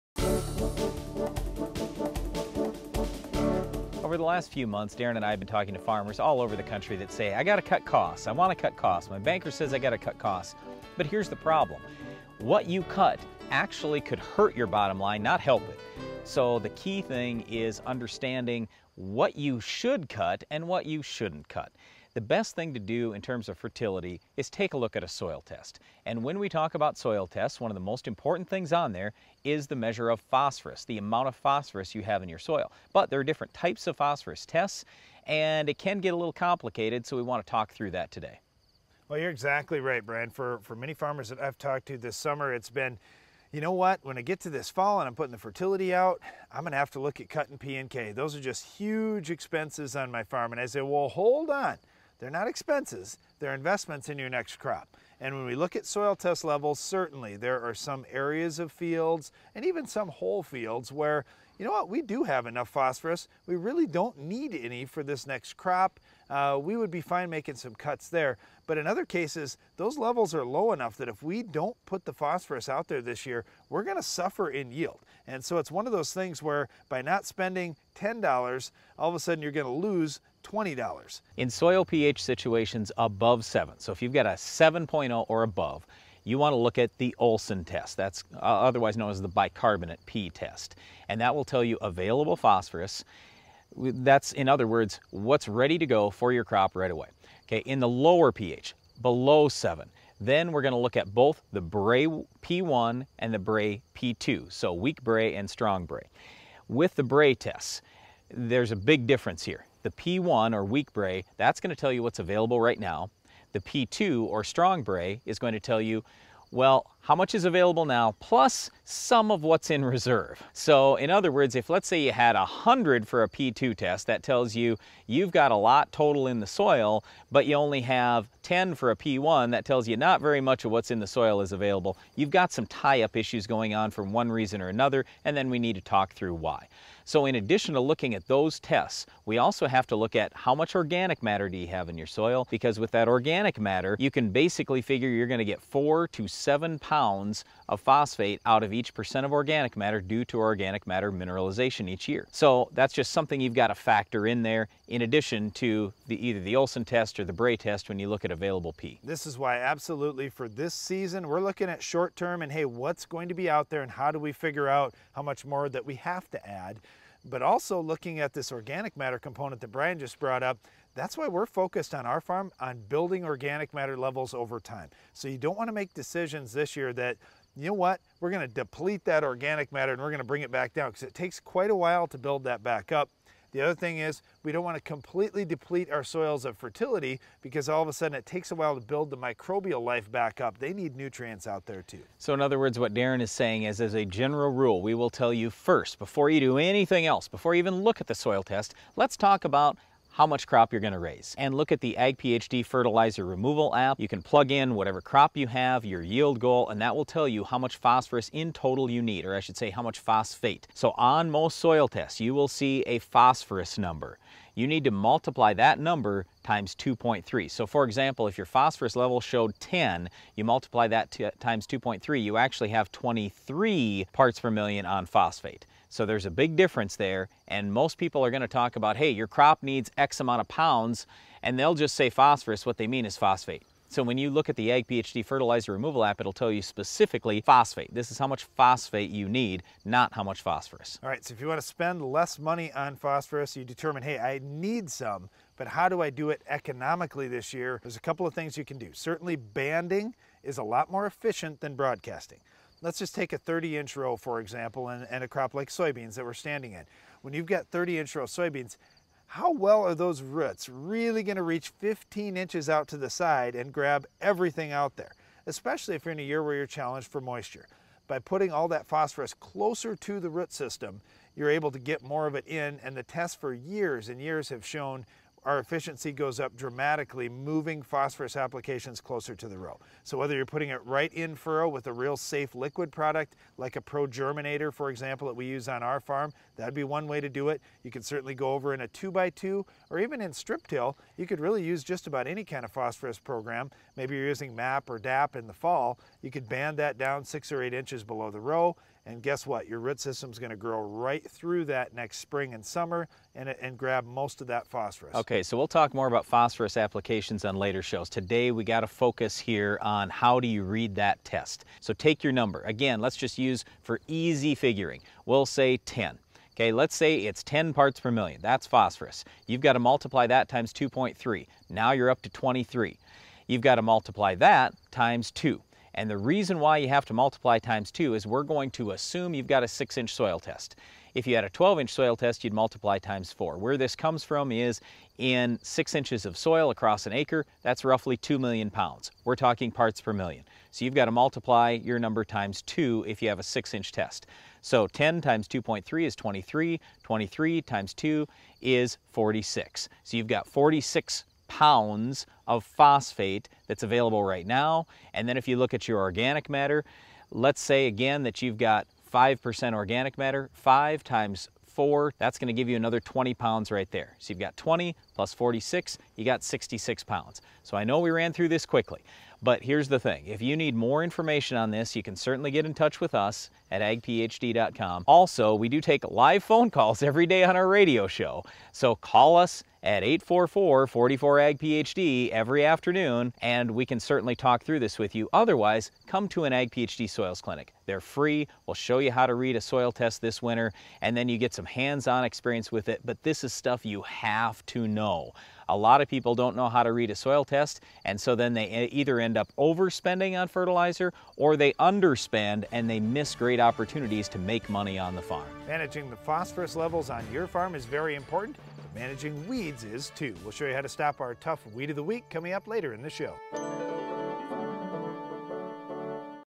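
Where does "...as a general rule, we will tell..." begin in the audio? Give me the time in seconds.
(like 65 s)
193 s.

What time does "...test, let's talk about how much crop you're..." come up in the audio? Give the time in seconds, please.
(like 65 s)
198 s.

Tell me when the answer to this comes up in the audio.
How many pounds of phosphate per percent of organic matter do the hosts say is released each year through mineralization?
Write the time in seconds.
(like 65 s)
145 s.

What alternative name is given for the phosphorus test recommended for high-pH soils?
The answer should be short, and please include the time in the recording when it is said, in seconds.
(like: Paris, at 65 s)
bicarbonate P test, at 89 s.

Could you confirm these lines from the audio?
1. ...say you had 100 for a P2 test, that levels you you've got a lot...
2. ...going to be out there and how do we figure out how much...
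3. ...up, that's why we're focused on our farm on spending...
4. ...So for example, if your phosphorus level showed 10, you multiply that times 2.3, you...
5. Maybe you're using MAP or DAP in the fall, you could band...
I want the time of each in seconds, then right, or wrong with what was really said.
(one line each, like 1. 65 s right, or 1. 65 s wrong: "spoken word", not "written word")
1. 121 s wrong: "tells", not "levels"
2. 163 s right
3. 170 s wrong: "building", not "spending"
4. 217 s right
5. 293 s right.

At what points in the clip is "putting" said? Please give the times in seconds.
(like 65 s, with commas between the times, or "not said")
45 s, 268 s, 280 s.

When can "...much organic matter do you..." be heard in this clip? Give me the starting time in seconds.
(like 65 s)
140 s.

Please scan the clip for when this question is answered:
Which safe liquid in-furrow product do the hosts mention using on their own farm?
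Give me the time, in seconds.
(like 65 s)
283 s.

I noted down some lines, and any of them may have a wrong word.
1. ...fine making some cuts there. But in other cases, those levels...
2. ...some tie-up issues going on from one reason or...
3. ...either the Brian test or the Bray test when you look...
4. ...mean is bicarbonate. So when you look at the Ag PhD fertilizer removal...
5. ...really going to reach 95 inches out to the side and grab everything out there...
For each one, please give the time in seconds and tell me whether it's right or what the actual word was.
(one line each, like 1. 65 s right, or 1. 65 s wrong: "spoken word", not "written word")
1. 67 s right
2. 132 s right
3. 156 s wrong: "Olsen", not "Brian"
4. 232 s wrong: "phosphate", not "bicarbonate"
5. 260 s wrong: "15", not "95".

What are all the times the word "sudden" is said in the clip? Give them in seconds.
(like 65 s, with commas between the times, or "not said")
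79 s, 187 s.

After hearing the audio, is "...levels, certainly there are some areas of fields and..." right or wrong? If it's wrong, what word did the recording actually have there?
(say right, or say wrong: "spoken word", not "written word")
right.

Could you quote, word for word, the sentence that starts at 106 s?
With the Bray tests, there's a big difference here.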